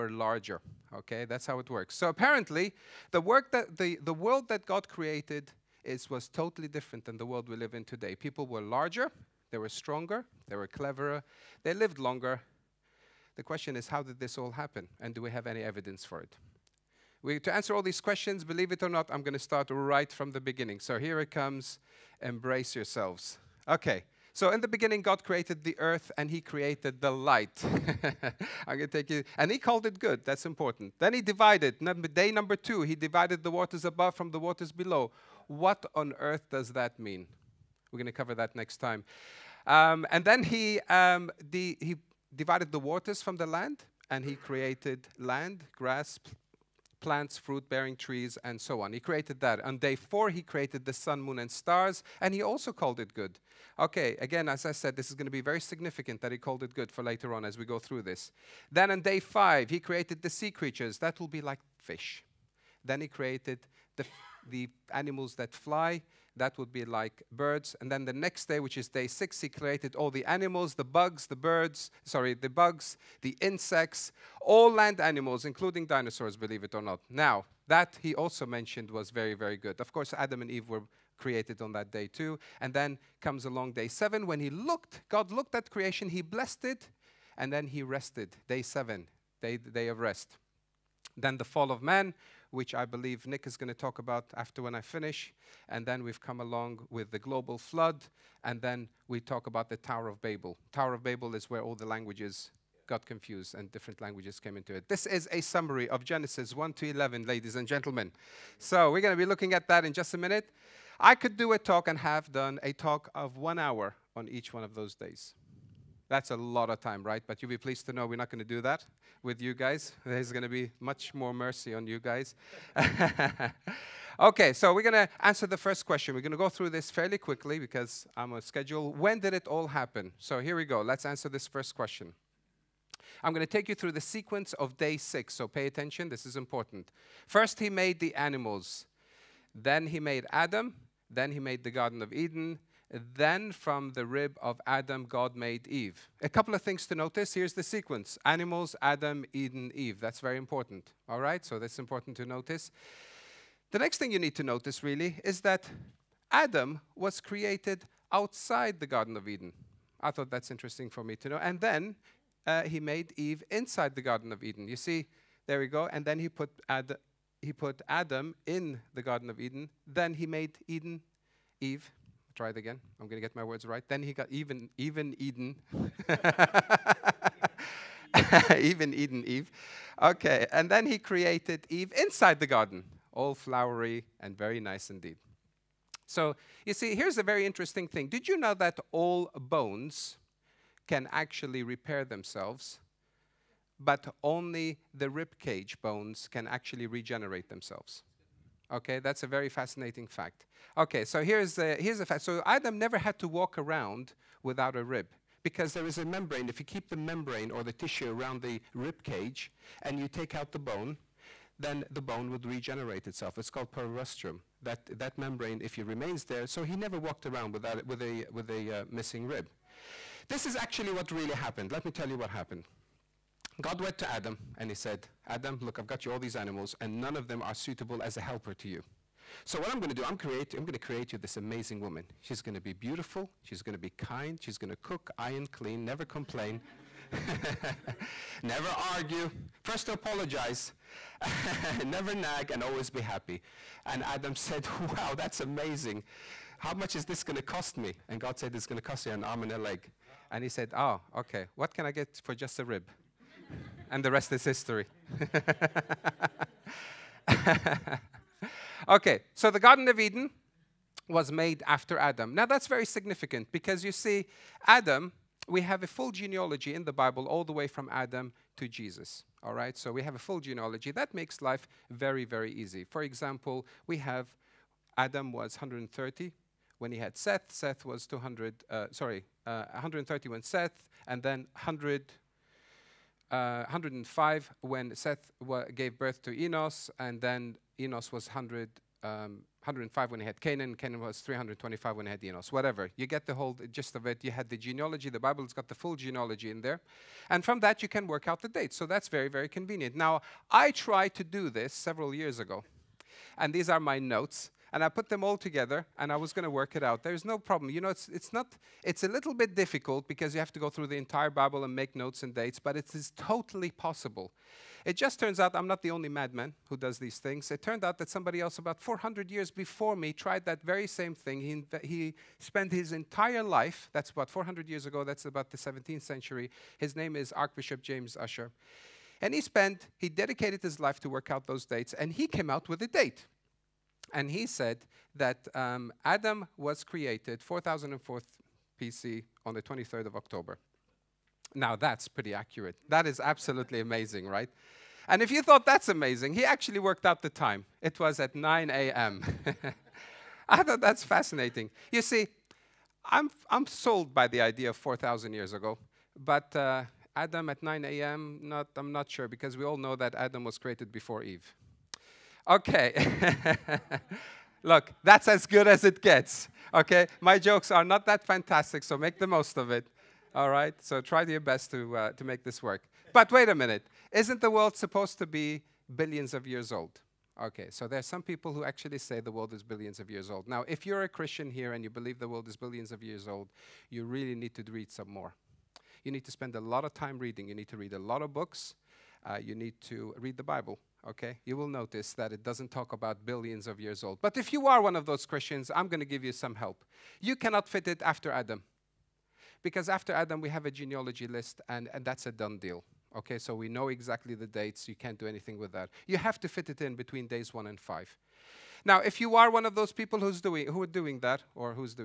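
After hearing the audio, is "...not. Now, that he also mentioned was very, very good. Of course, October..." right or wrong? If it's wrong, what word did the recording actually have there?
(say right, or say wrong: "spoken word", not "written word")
wrong: "Adam", not "October".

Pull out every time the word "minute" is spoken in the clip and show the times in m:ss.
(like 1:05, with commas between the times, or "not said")
1:50, 6:13.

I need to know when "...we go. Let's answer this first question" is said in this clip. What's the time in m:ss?
2:10.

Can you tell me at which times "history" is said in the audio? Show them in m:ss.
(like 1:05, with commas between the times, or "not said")
4:14.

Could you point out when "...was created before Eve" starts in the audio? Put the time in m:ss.
6:00.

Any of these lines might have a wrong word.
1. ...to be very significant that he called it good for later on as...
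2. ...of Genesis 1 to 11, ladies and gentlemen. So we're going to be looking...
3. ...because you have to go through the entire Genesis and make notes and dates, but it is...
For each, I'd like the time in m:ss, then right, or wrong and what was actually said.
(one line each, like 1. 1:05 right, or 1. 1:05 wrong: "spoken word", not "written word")
1. 0:55 right
2. 1:45 right
3. 5:10 wrong: "Bible", not "Genesis".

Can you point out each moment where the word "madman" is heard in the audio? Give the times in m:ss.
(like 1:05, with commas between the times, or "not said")
5:16.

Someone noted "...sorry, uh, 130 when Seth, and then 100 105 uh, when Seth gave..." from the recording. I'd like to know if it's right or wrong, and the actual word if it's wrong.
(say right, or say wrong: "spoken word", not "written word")
right.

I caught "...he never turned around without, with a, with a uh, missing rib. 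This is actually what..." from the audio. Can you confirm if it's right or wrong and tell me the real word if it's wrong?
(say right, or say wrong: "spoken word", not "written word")
wrong: "walked", not "turned".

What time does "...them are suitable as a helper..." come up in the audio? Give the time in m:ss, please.
3:47.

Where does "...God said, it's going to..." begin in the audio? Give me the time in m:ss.
4:08.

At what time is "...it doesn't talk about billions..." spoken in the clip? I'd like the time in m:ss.
6:32.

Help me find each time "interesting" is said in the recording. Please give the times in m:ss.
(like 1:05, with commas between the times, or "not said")
2:40, 3:07.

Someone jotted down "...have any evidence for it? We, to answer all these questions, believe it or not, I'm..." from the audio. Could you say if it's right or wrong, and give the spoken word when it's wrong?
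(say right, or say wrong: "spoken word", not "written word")
right.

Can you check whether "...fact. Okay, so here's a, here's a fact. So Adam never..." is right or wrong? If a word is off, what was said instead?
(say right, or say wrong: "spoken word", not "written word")
right.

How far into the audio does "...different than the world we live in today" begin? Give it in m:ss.
0:06.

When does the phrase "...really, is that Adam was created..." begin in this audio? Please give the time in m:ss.
2:34.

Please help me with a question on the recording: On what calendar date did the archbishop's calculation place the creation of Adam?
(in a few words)
23rd of October.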